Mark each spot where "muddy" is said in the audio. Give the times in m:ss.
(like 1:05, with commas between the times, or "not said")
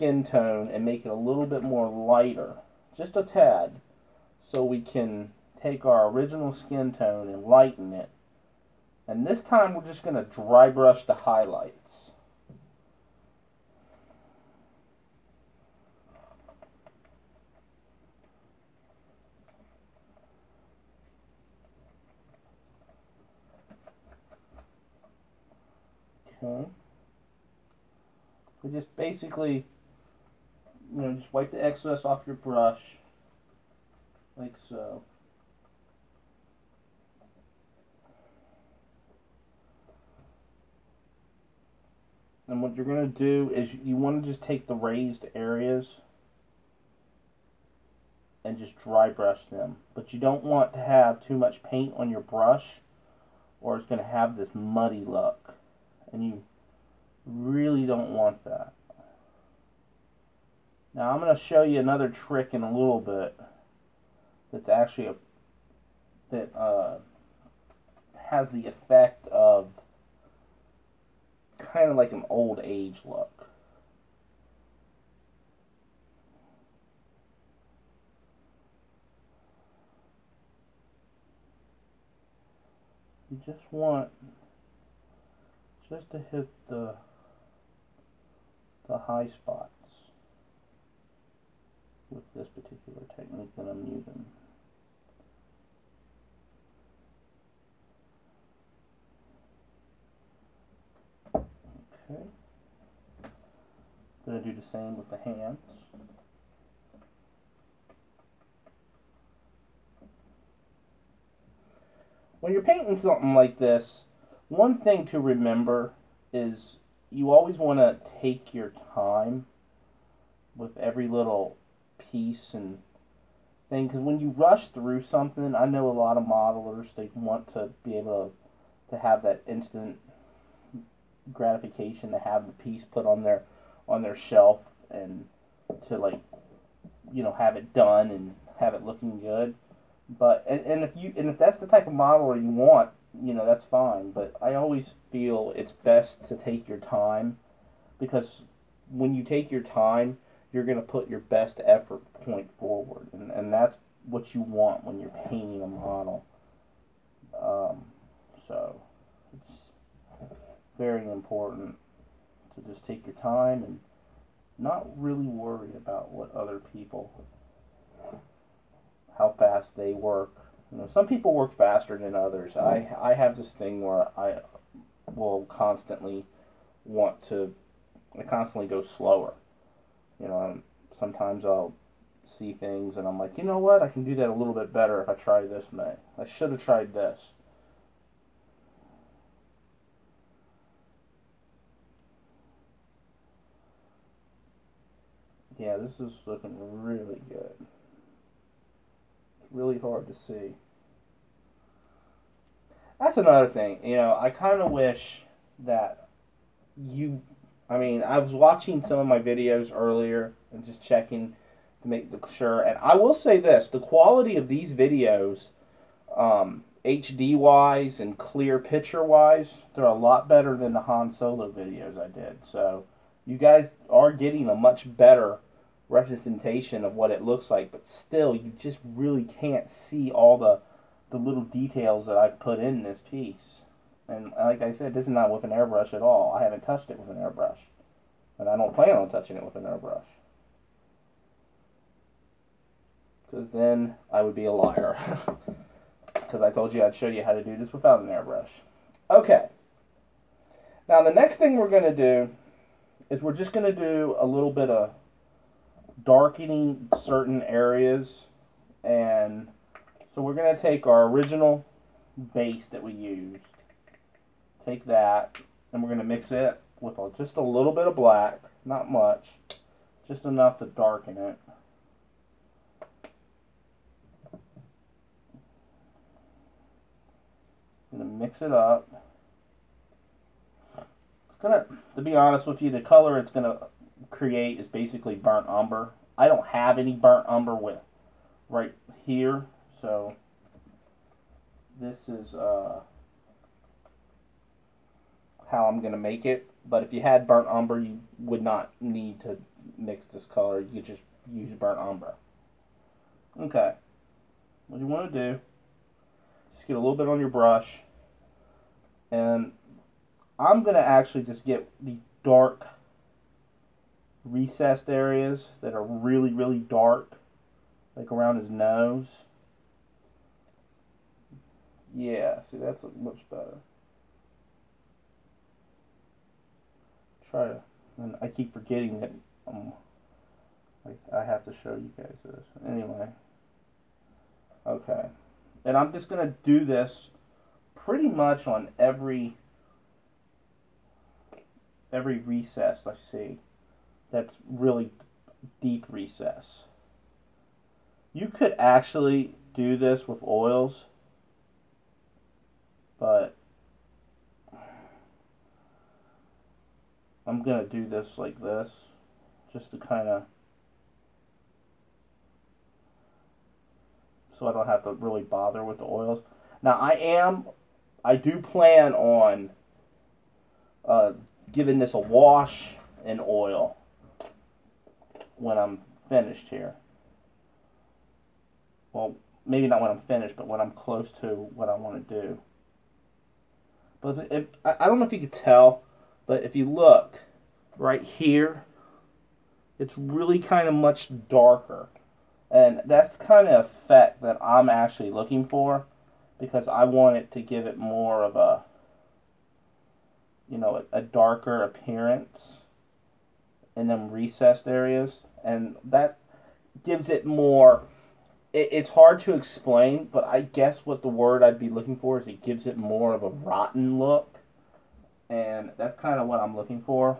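0:54.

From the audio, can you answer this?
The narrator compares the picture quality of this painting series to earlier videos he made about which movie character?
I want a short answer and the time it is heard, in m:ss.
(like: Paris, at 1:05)
Han Solo, at 3:40.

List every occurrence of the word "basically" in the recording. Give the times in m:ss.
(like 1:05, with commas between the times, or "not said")
0:28, 4:44.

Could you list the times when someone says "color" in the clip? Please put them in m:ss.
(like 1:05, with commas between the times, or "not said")
4:42, 5:00.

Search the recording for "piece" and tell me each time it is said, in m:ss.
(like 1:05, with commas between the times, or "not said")
2:02, 2:12, 3:53.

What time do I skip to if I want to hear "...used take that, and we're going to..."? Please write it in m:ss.
4:22.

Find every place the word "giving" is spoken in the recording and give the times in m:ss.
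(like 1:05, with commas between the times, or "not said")
6:11.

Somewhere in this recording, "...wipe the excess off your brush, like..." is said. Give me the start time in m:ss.
0:31.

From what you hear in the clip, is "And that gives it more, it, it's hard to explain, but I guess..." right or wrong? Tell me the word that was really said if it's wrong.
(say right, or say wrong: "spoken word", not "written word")
right.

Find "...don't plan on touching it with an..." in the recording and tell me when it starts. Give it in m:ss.
3:58.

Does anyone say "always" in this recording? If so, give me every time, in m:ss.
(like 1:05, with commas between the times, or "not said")
1:57, 2:24.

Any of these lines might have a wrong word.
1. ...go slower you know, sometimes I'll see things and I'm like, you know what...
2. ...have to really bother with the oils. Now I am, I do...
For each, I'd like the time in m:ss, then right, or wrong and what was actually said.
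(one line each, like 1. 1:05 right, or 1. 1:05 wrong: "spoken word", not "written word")
1. 2:58 right
2. 6:04 right.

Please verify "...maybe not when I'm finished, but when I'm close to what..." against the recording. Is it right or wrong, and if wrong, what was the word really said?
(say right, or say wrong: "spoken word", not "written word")
right.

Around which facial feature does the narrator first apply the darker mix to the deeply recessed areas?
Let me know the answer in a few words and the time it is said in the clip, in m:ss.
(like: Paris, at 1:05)
His nose, at 5:18.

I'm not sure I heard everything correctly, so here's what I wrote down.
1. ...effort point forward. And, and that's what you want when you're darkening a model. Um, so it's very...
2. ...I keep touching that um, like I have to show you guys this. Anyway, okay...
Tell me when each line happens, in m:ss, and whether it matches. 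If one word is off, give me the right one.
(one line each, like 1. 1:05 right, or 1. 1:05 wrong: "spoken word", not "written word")
1. 2:31 wrong: "painting", not "darkening"
2. 5:28 wrong: "forgetting", not "touching".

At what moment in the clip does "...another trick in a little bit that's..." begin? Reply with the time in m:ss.
1:01.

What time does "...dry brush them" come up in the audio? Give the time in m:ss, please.
0:48.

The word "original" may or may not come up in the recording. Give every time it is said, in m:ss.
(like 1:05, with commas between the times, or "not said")
0:06, 4:21.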